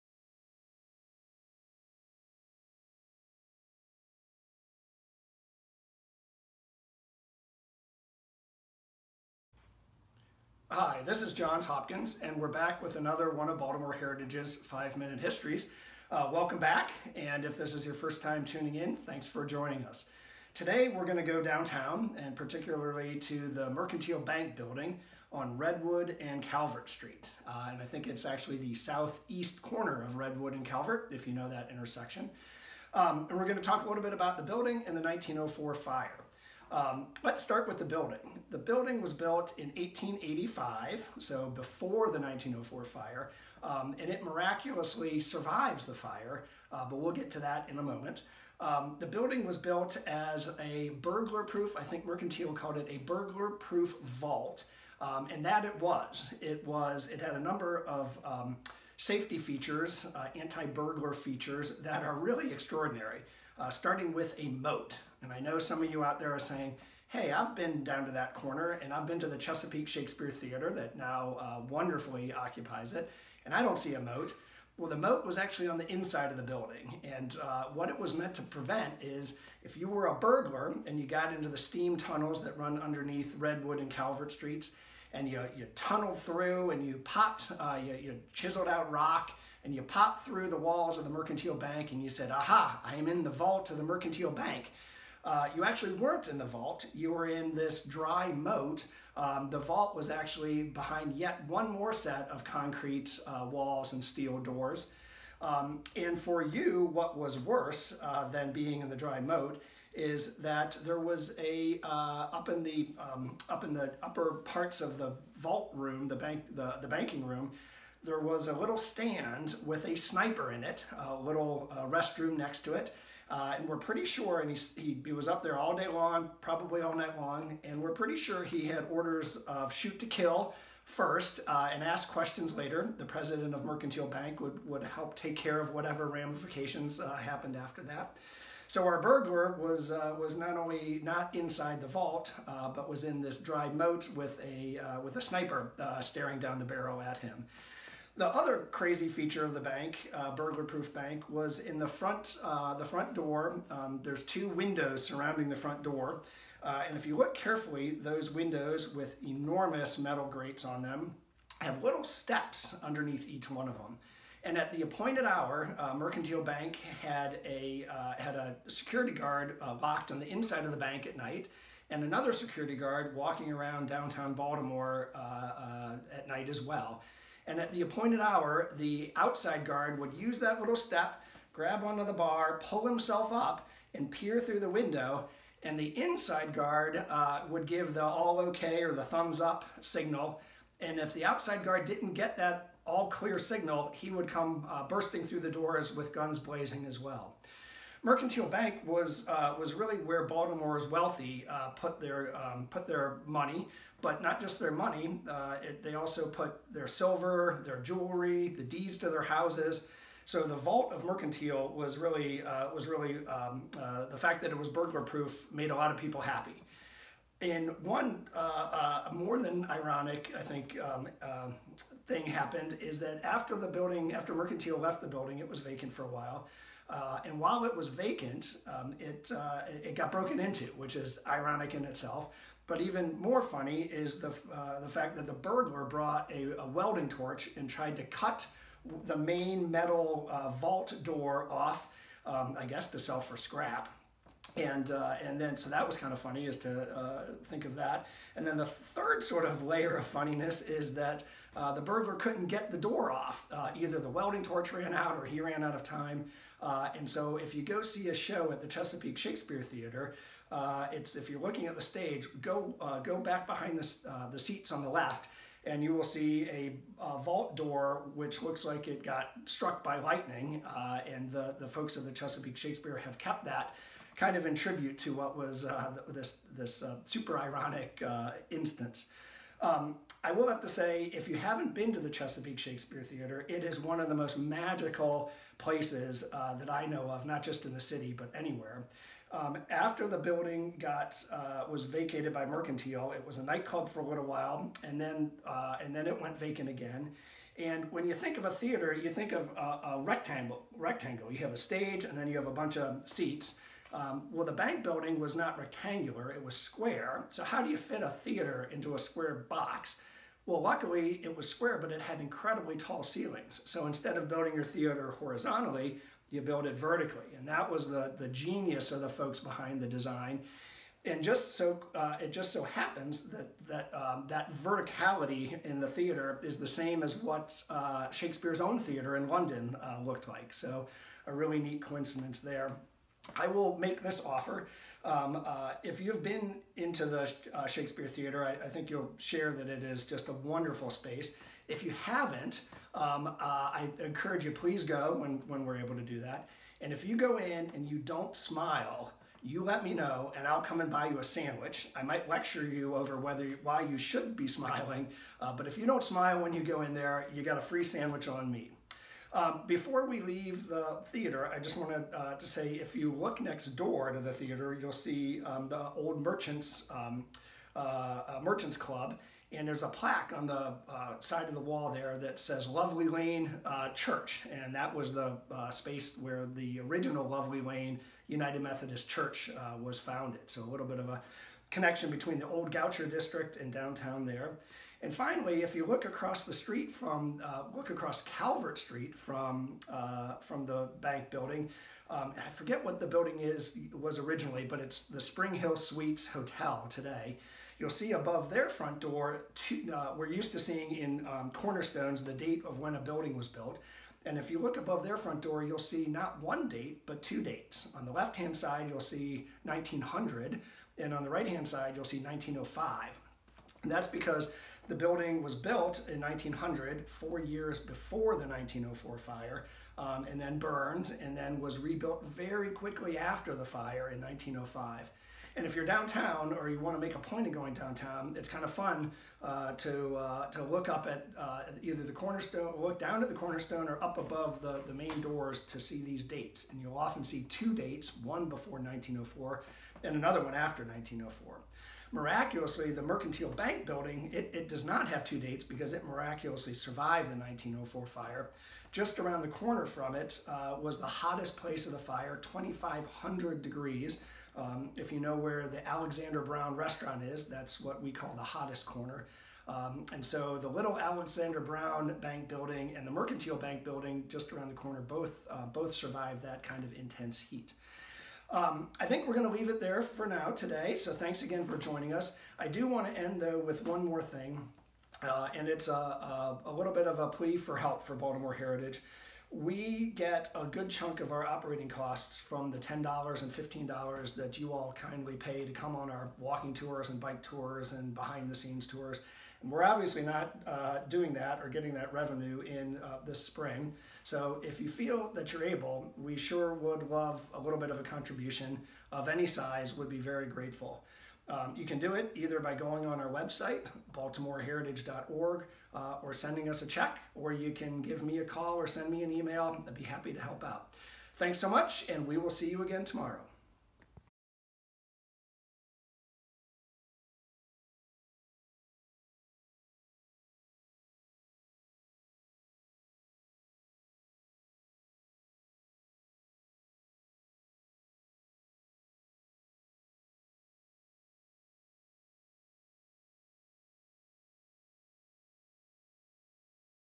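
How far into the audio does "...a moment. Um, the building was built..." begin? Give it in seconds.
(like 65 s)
47 s.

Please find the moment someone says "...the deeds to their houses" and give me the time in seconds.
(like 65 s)
208 s.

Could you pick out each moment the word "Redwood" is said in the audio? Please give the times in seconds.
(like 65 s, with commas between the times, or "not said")
25 s, 30 s, 83 s.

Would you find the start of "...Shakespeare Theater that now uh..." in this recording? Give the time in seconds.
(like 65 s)
69 s.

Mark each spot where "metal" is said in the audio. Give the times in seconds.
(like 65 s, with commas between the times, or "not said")
159 s, 239 s.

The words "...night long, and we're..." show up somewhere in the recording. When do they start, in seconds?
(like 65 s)
126 s.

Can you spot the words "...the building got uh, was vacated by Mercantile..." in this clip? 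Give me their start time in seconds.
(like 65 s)
290 s.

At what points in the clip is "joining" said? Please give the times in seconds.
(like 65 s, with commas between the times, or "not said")
19 s, 471 s.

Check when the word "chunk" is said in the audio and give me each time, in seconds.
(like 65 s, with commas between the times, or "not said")
480 s.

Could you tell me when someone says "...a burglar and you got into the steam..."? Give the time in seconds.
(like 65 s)
80 s.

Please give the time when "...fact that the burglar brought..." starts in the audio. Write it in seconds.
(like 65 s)
234 s.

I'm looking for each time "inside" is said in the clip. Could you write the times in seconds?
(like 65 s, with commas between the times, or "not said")
75 s, 141 s, 170 s, 186 s.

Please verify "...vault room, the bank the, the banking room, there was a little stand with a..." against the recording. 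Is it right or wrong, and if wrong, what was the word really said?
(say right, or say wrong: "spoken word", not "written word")
right.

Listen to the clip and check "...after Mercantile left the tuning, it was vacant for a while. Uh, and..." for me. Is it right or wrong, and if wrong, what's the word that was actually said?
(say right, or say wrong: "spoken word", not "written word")
wrong: "building", not "tuning".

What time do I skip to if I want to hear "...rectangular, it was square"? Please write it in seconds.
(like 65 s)
305 s.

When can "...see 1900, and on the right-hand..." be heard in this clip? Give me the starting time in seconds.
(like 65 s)
408 s.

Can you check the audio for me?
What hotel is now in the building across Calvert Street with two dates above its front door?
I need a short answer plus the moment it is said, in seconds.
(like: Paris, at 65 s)
Spring Hill Suites, at 395 s.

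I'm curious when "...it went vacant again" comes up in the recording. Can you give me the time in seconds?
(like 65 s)
296 s.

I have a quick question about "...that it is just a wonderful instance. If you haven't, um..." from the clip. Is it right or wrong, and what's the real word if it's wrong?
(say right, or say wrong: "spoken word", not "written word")
wrong: "space", not "instance".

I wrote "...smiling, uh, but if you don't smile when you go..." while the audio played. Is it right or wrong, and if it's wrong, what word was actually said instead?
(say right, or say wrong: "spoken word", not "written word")
right.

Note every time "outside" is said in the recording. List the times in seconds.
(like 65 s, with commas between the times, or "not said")
179 s, 191 s.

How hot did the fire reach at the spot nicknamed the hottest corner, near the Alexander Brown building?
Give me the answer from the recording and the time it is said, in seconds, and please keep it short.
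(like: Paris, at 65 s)
2,500 degrees, at 452 s.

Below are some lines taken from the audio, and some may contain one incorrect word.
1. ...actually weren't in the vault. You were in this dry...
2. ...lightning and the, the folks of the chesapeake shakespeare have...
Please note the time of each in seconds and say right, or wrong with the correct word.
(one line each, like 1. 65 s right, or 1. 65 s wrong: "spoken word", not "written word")
1. 95 s right
2. 269 s right.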